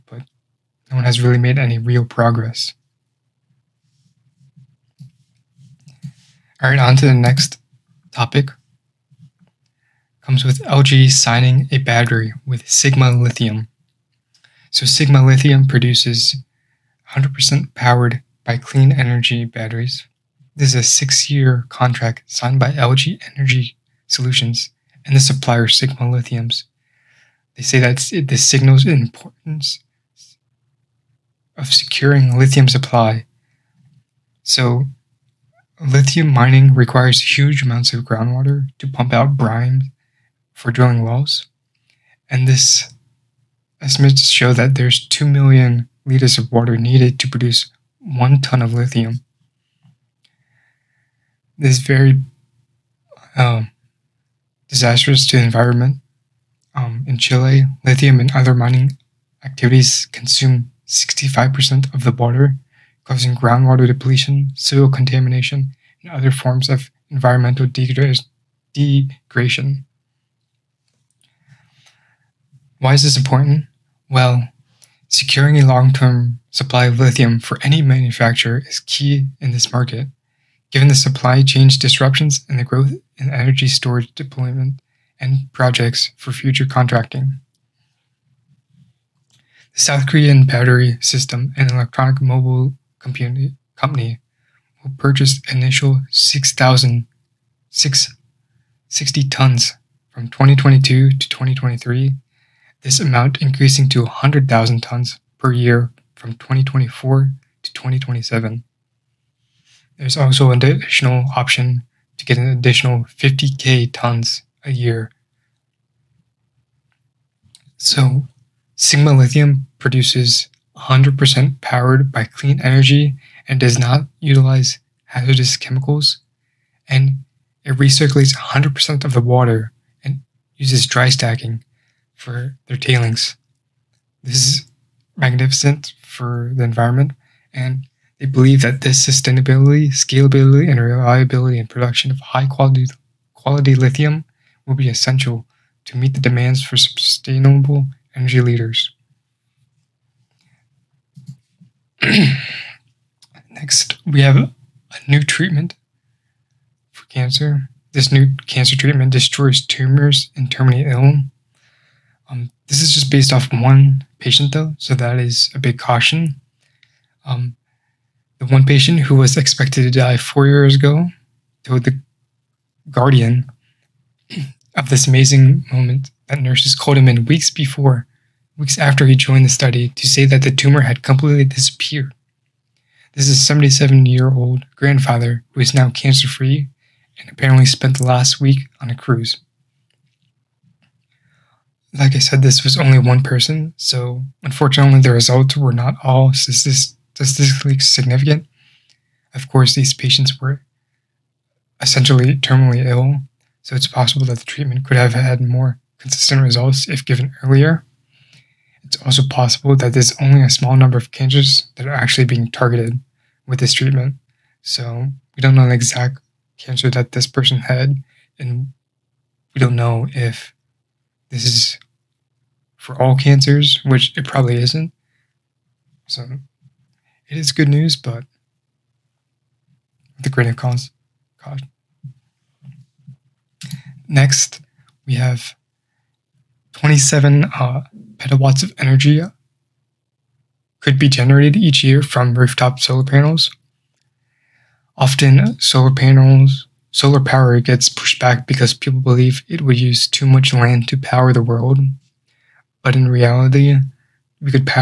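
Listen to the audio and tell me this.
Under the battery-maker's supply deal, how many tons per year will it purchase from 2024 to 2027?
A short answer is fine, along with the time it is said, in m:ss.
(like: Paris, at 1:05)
100,000 tons, at 1:44.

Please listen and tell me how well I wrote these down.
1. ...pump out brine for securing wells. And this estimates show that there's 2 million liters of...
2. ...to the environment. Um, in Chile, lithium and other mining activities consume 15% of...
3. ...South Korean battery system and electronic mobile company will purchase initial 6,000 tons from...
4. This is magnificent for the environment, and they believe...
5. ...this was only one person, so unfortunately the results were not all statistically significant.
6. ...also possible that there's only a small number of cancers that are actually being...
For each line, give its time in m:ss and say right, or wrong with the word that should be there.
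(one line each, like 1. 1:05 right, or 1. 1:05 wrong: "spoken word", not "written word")
1. 0:38 wrong: "drilling", not "securing"
2. 0:55 wrong: "65", not "15"
3. 1:29 right
4. 2:14 right
5. 3:12 right
6. 3:29 right.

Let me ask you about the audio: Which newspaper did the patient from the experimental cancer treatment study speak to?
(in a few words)
The Guardian.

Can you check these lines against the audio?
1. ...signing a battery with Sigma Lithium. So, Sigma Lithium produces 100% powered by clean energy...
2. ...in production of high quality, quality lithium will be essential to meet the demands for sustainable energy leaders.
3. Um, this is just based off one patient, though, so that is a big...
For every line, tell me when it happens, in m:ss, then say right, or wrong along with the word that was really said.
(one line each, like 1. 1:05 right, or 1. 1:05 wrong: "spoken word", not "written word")
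1. 0:11 right
2. 2:21 right
3. 2:42 right.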